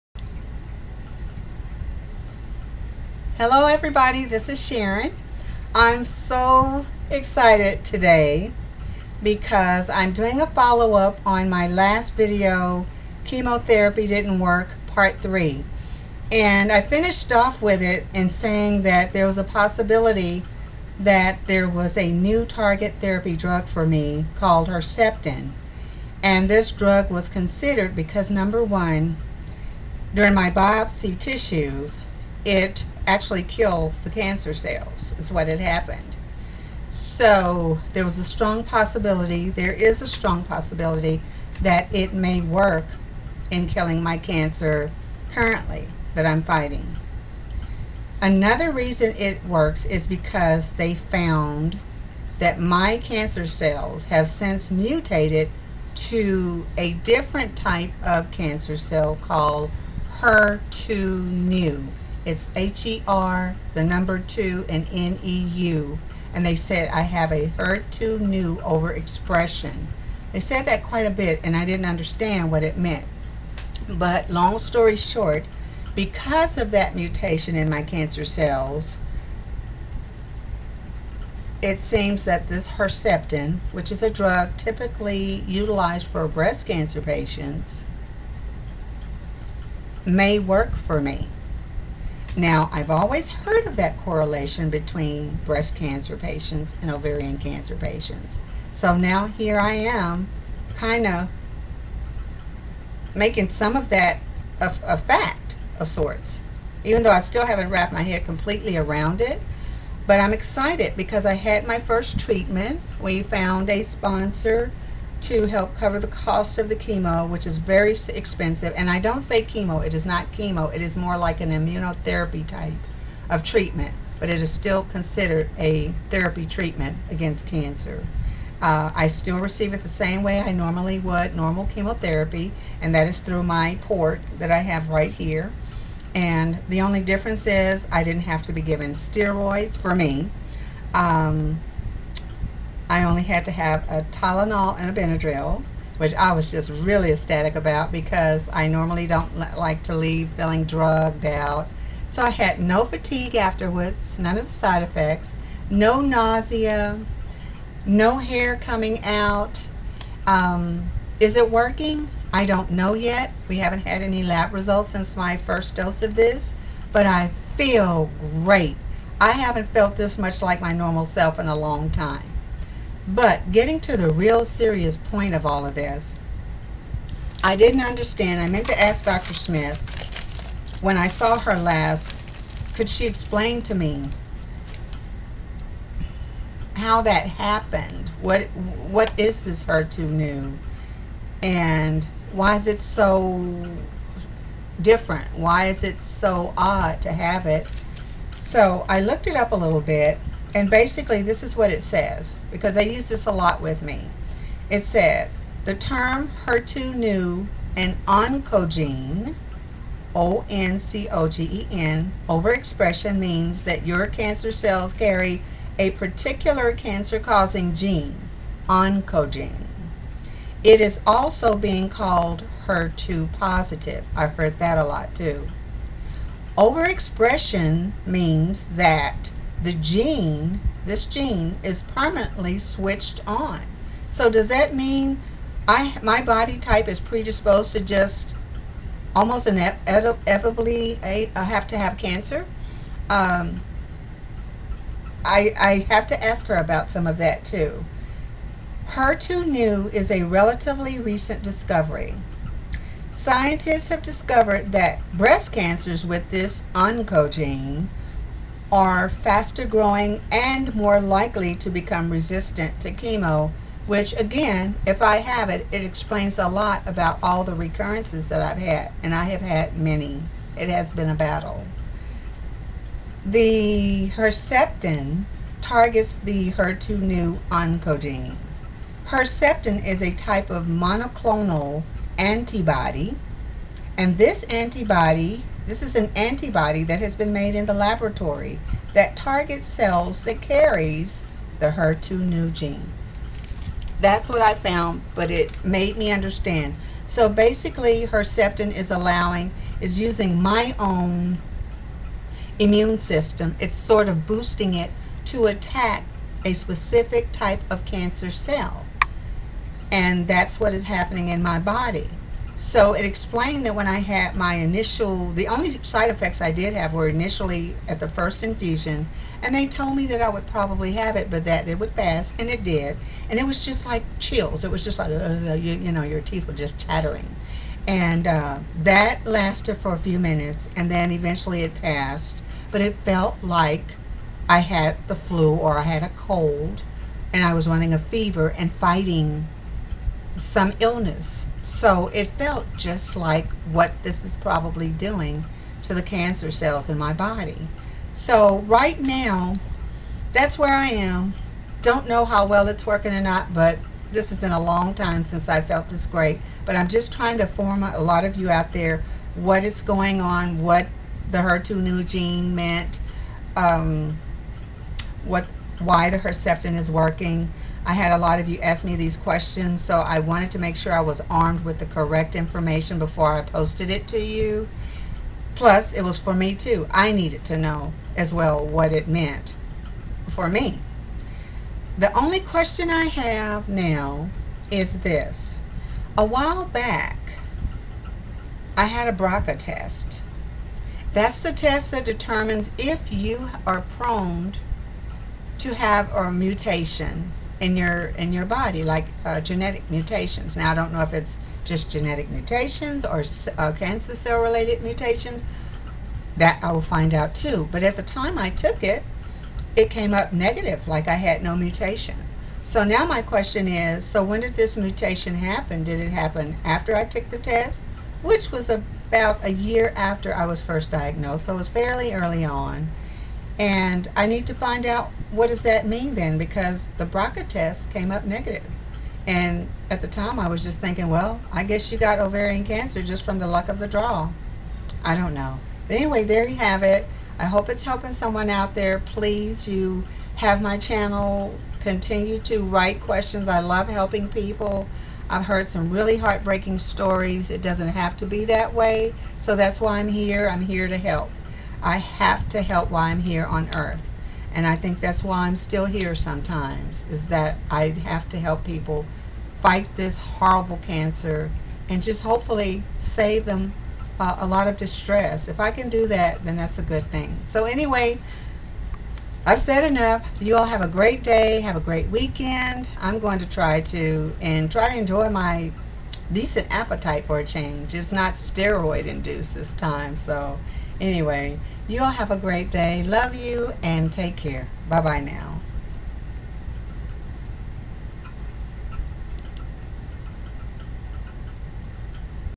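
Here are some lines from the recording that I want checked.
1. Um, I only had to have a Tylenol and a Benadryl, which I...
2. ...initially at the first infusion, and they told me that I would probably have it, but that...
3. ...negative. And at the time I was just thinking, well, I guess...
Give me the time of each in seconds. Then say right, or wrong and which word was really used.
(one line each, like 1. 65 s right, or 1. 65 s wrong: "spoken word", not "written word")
1. 140 s right
2. 317 s right
3. 428 s right.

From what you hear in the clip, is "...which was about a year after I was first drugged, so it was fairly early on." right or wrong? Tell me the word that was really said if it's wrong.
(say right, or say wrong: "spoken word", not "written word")
wrong: "diagnosed", not "drugged".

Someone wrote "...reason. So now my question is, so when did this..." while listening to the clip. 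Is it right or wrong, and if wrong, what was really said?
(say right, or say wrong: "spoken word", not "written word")
wrong: "mutation", not "reason".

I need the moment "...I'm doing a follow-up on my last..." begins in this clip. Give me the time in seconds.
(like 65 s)
9 s.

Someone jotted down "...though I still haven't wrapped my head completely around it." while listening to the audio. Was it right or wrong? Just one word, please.
right.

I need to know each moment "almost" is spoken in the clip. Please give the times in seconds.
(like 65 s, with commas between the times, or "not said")
239 s.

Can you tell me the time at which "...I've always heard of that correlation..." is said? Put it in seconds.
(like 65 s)
92 s.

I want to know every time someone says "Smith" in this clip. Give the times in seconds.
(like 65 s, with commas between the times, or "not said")
179 s.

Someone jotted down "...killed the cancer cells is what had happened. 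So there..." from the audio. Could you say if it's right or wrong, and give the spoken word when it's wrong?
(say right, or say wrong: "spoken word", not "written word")
right.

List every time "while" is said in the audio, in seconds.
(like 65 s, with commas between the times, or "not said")
386 s, 452 s.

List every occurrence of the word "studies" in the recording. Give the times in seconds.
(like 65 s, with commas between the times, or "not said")
not said.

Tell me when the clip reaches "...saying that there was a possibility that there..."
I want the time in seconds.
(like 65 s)
18 s.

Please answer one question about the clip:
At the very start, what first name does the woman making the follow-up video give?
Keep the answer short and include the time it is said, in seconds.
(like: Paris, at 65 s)
Sharon, at 4 s.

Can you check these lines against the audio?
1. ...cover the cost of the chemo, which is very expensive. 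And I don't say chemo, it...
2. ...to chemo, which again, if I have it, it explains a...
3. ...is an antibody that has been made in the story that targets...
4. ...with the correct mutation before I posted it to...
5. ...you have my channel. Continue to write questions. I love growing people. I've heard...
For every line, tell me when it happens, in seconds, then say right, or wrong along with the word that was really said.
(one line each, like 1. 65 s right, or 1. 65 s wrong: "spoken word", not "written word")
1. 115 s right
2. 262 s right
3. 285 s wrong: "laboratory", not "story"
4. 371 s wrong: "information", not "mutation"
5. 439 s wrong: "helping", not "growing".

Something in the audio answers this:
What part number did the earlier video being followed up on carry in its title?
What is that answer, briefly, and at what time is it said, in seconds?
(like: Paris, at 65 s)
Part 3, at 14 s.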